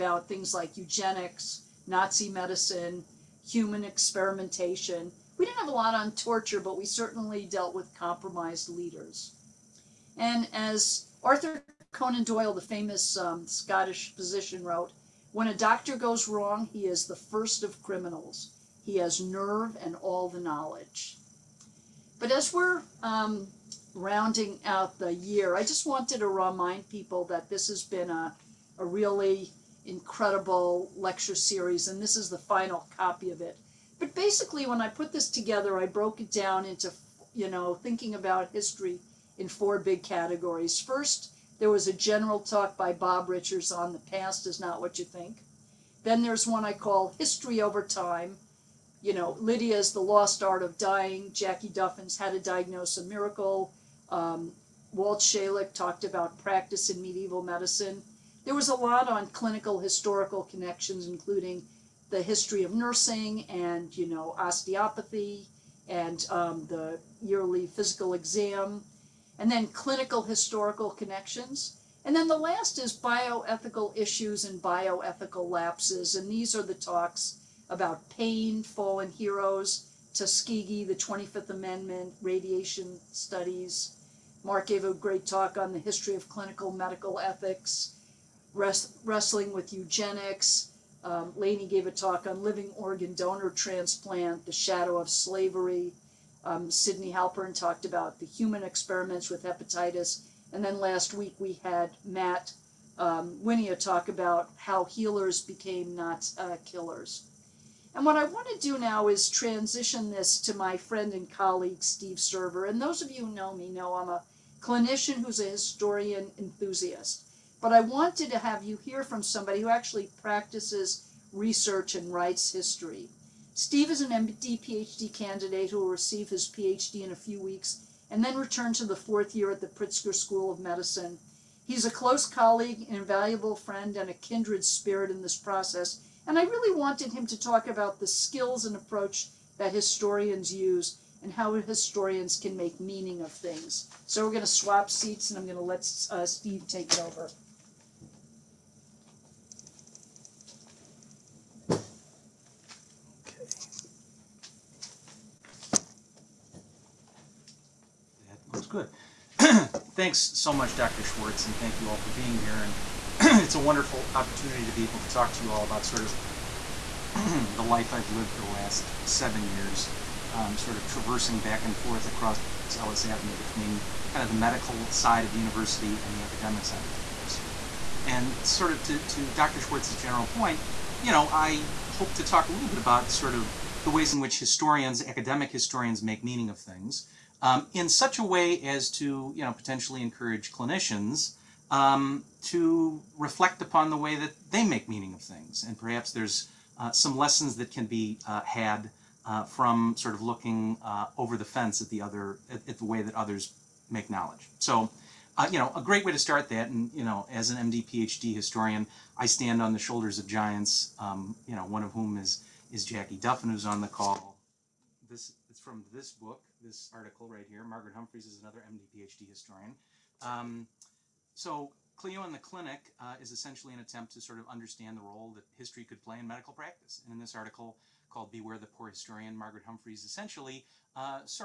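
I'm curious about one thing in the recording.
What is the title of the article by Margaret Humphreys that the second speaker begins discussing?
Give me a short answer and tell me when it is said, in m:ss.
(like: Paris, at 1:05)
Beware the Poor Historian, at 3:48.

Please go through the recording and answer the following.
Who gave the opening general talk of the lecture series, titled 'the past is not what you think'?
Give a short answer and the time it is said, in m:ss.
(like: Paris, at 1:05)
Bob Richards, at 0:42.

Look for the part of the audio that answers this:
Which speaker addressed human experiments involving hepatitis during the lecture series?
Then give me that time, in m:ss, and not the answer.
1:36.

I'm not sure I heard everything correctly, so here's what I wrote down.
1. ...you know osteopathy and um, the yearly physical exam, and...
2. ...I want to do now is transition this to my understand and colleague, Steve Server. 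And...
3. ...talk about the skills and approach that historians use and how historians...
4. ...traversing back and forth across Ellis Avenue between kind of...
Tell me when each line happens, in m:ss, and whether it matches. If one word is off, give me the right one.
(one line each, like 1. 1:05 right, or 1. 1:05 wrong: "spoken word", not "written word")
1. 1:03 right
2. 1:48 wrong: "friend", not "understand"
3. 2:17 right
4. 2:50 right.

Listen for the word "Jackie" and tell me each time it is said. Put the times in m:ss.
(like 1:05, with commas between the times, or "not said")
0:51, 3:32.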